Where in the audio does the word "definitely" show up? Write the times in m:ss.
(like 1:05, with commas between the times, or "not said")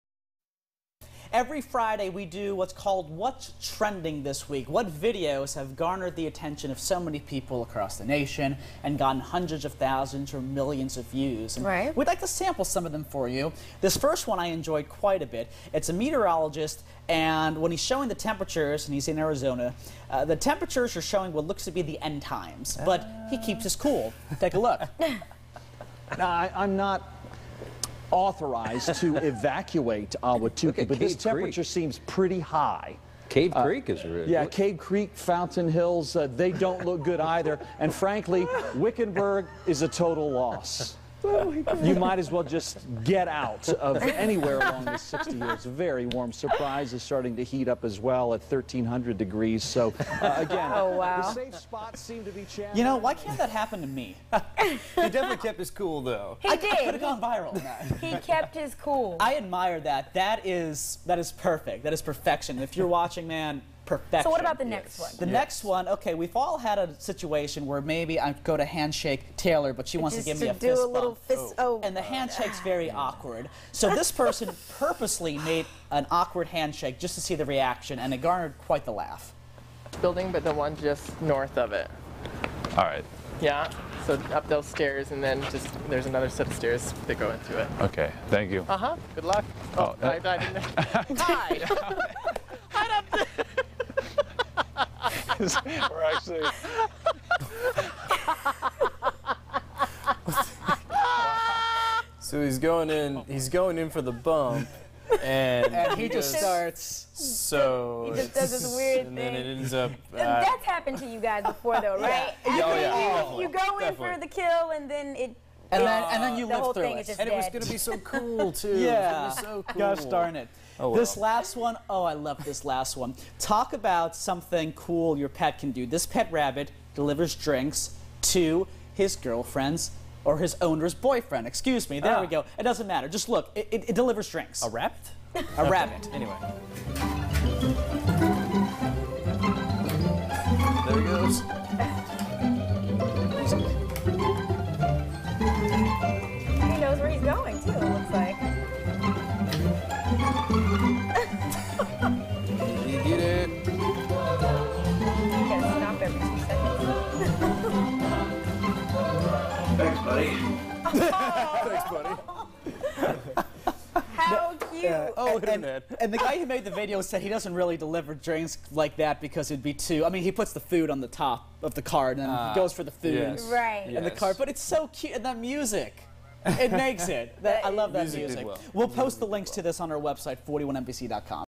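0:54, 1:53.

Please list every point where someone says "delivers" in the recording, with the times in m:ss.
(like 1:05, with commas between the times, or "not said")
2:06, 2:13, 2:47.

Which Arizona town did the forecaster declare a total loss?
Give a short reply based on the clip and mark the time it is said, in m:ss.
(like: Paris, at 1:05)
Wickenburg, at 0:38.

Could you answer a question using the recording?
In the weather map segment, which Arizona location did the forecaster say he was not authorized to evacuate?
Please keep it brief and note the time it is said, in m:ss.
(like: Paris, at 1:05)
Ahwatukee, at 0:30.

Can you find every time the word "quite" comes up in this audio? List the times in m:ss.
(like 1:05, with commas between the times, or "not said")
0:14, 1:18.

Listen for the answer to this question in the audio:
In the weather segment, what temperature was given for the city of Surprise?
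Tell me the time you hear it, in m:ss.
0:48.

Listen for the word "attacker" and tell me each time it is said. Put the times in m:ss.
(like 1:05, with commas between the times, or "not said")
not said.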